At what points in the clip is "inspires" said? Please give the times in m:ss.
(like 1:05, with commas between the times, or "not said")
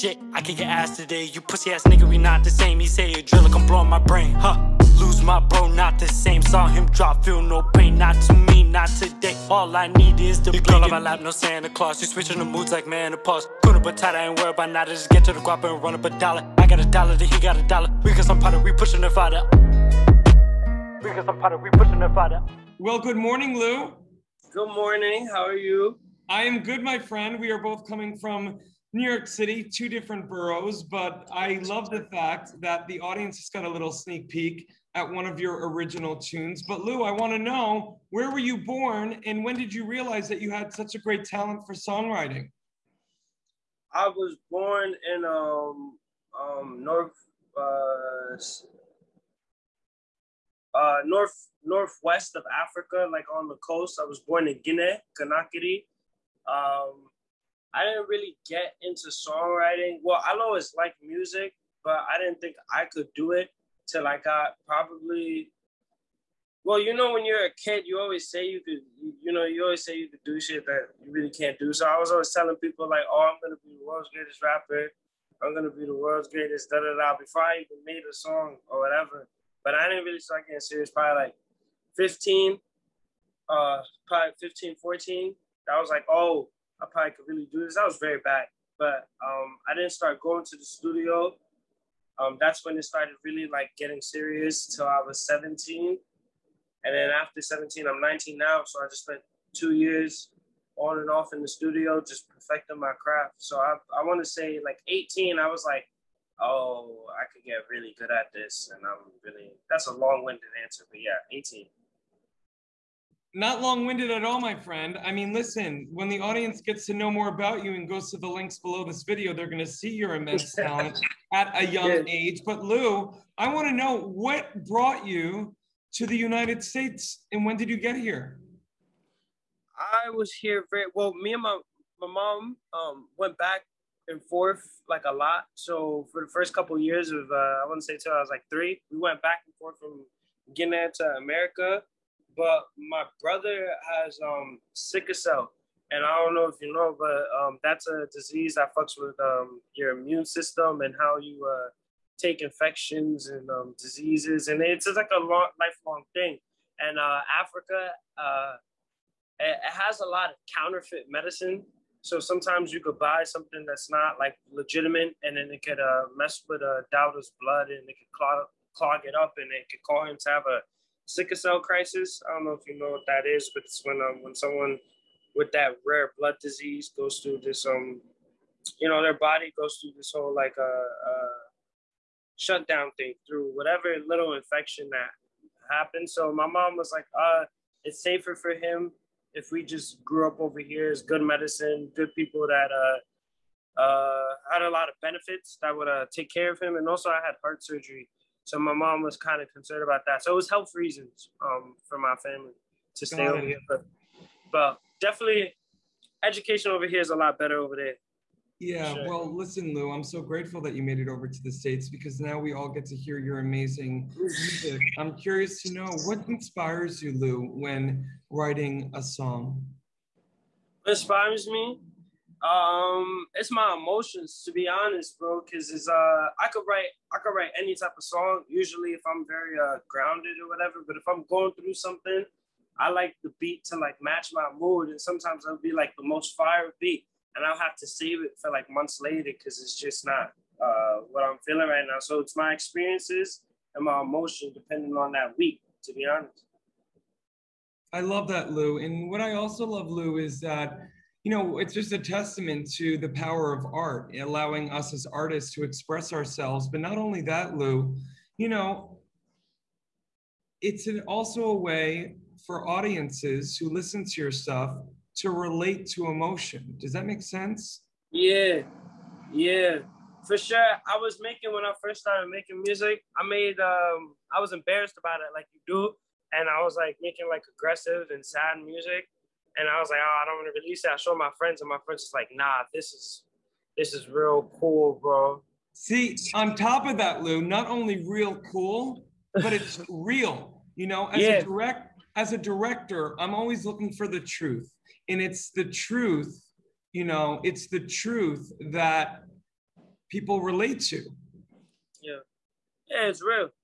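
3:36, 3:40.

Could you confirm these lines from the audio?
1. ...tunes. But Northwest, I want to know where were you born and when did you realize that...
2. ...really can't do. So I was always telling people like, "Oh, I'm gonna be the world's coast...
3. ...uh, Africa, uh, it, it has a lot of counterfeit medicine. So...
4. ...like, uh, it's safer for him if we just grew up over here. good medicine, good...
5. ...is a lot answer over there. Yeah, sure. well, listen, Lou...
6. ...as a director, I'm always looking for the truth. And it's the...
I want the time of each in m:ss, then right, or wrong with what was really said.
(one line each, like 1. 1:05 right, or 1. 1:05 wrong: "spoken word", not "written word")
1. 0:36 wrong: "Lou", not "Northwest"
2. 1:11 wrong: "greatest", not "coast"
3. 2:36 right
4. 3:06 right
5. 3:27 wrong: "better", not "answer"
6. 4:52 right.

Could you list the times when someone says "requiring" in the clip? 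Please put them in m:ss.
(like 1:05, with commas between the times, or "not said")
not said.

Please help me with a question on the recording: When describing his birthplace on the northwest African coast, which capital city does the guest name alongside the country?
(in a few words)
Conakry.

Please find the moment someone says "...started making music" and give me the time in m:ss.
4:32.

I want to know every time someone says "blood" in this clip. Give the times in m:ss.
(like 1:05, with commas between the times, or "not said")
2:47, 2:56.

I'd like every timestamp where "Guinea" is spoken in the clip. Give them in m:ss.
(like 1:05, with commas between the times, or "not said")
0:54, 2:20.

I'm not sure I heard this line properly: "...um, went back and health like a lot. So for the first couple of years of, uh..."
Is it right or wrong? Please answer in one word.
wrong.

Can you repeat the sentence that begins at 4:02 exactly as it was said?
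So it's my experiences and my emotion depending on that week.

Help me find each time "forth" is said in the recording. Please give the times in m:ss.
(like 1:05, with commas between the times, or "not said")
2:14, 2:19.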